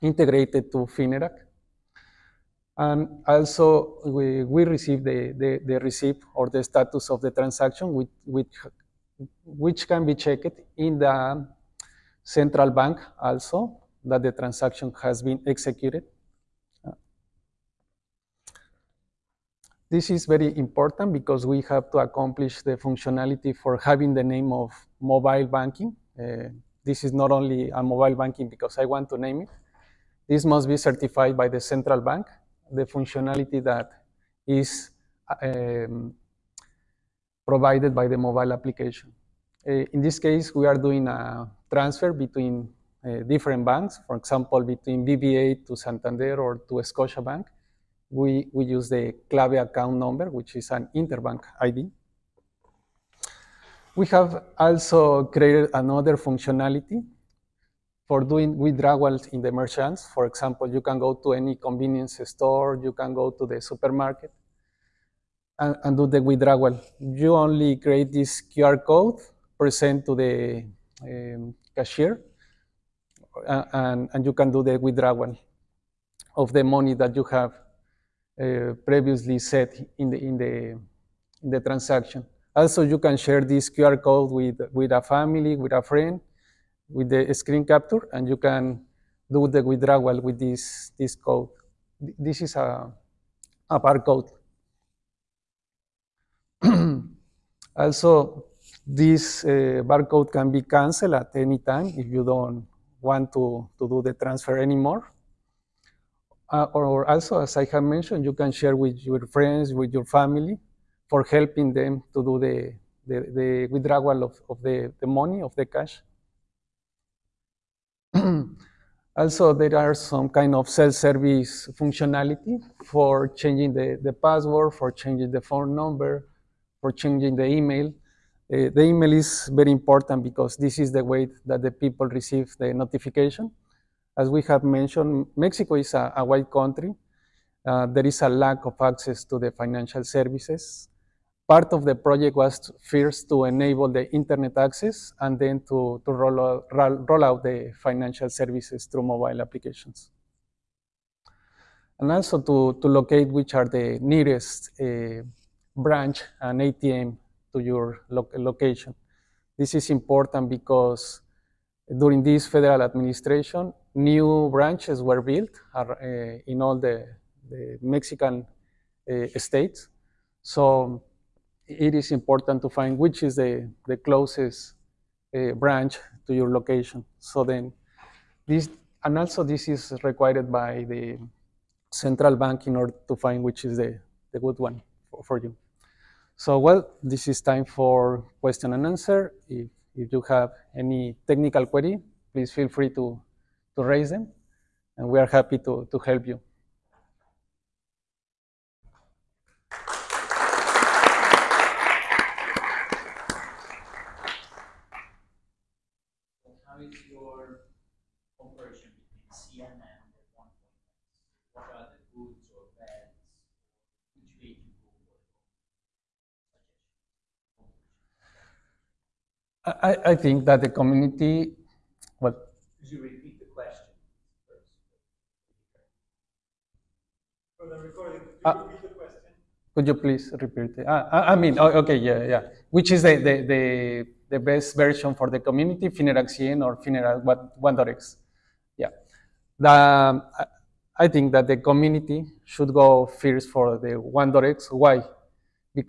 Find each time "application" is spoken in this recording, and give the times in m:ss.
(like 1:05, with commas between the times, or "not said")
0:38, 2:29.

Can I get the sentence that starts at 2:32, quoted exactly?
And also to, to locate which are the nearest uh, branch and ATM to your lo location.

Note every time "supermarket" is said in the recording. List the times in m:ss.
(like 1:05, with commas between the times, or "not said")
1:03.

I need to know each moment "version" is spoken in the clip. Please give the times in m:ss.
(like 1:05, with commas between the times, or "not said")
3:54.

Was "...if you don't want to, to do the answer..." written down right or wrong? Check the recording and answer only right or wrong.
wrong.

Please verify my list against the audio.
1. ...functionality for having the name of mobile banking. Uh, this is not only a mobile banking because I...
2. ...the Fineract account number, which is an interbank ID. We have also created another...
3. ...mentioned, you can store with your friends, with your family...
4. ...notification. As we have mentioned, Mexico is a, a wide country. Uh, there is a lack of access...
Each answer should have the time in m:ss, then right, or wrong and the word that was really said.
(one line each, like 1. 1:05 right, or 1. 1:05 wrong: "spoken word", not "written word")
1. 0:22 right
2. 0:48 wrong: "CLABE", not "Fineract"
3. 1:47 wrong: "share", not "store"
4. 2:12 right.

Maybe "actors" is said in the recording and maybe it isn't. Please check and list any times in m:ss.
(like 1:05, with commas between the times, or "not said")
not said.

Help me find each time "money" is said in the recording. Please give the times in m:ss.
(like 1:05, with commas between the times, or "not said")
1:16, 1:55.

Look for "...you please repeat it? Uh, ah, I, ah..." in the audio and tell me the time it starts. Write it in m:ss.
3:49.